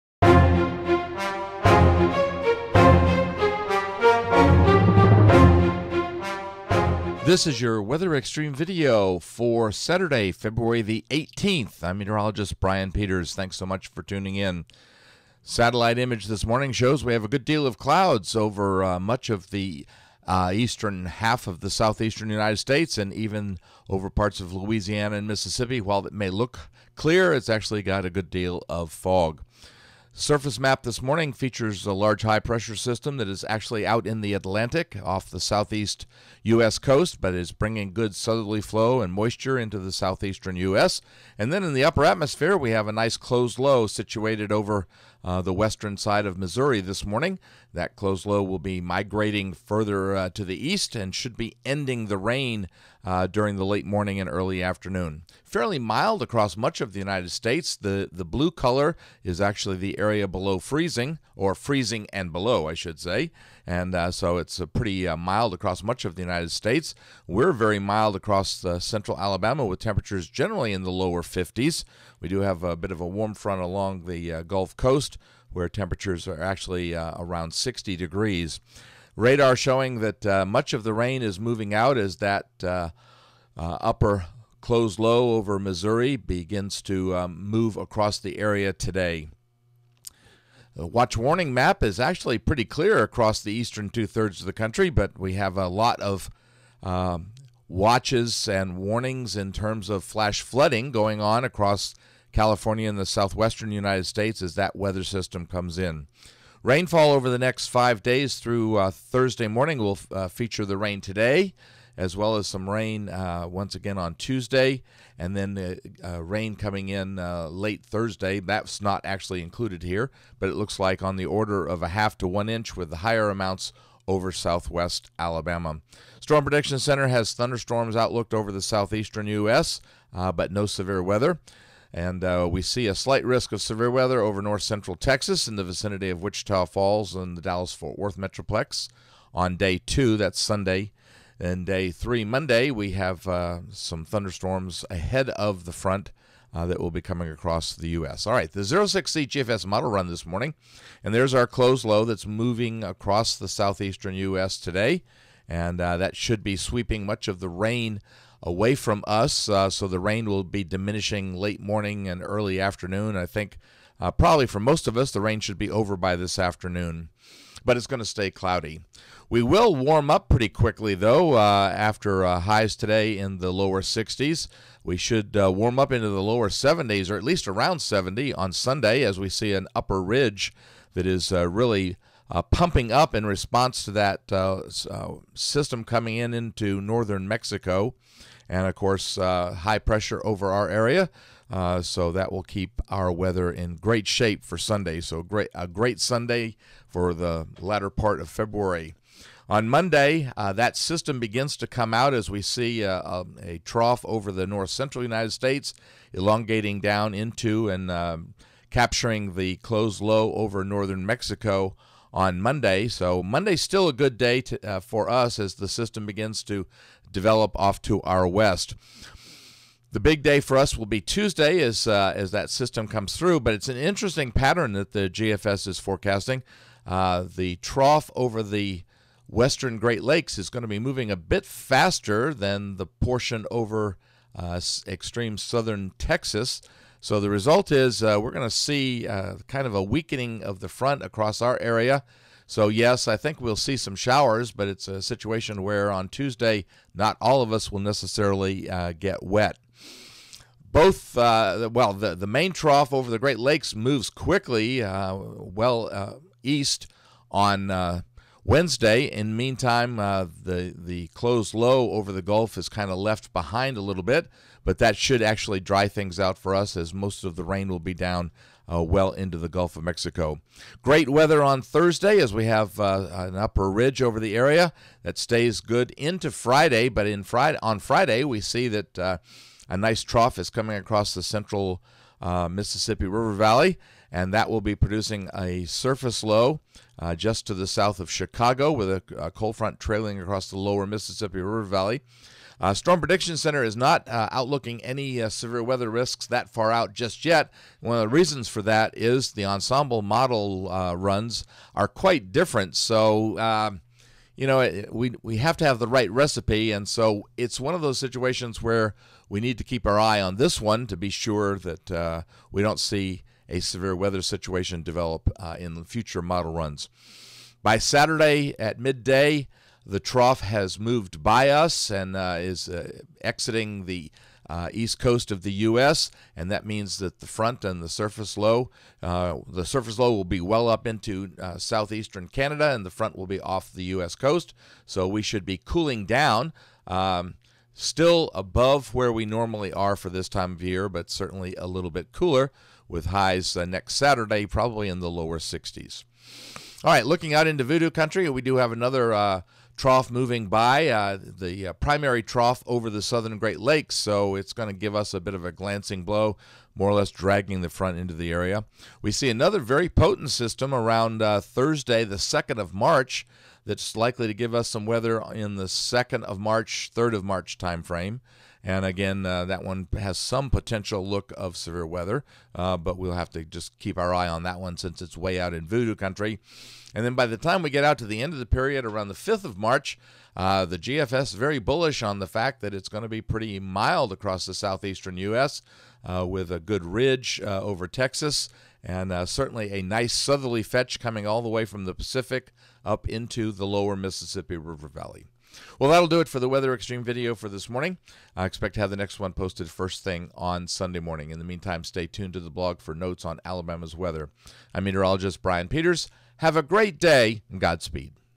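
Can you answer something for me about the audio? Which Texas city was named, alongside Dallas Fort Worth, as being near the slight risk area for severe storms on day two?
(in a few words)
Wichita Falls.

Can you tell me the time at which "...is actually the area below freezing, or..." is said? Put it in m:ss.
0:59.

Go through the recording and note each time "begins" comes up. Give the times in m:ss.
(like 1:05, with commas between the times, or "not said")
1:26, 3:21, 3:36.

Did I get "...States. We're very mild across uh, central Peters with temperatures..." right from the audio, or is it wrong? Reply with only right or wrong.
wrong.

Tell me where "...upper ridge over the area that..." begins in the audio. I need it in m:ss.
4:33.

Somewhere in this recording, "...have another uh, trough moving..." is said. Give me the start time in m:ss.
5:48.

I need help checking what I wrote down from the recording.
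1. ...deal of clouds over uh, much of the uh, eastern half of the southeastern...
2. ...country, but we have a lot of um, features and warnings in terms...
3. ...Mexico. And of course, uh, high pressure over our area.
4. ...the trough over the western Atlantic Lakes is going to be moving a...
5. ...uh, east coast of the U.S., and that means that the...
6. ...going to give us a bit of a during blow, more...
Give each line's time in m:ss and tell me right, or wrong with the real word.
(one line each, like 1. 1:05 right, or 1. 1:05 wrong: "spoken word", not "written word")
1. 0:17 right
2. 1:34 wrong: "watches", not "features"
3. 3:07 right
4. 3:47 wrong: "Great", not "Atlantic"
5. 5:24 right
6. 5:54 wrong: "glancing", not "during".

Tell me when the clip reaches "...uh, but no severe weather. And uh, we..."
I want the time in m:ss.
2:10.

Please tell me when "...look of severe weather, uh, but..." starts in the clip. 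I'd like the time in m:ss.
6:11.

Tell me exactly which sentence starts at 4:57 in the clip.
One of the reasons for that is the ensemble model uh, runs are quite different.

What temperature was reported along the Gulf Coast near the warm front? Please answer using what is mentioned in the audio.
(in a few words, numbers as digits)
60 degrees.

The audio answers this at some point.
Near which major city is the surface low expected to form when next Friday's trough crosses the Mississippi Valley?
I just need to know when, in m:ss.
4:48.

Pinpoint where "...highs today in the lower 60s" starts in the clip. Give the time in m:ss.
2:52.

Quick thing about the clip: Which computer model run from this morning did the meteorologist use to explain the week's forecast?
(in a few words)
06Z GFS.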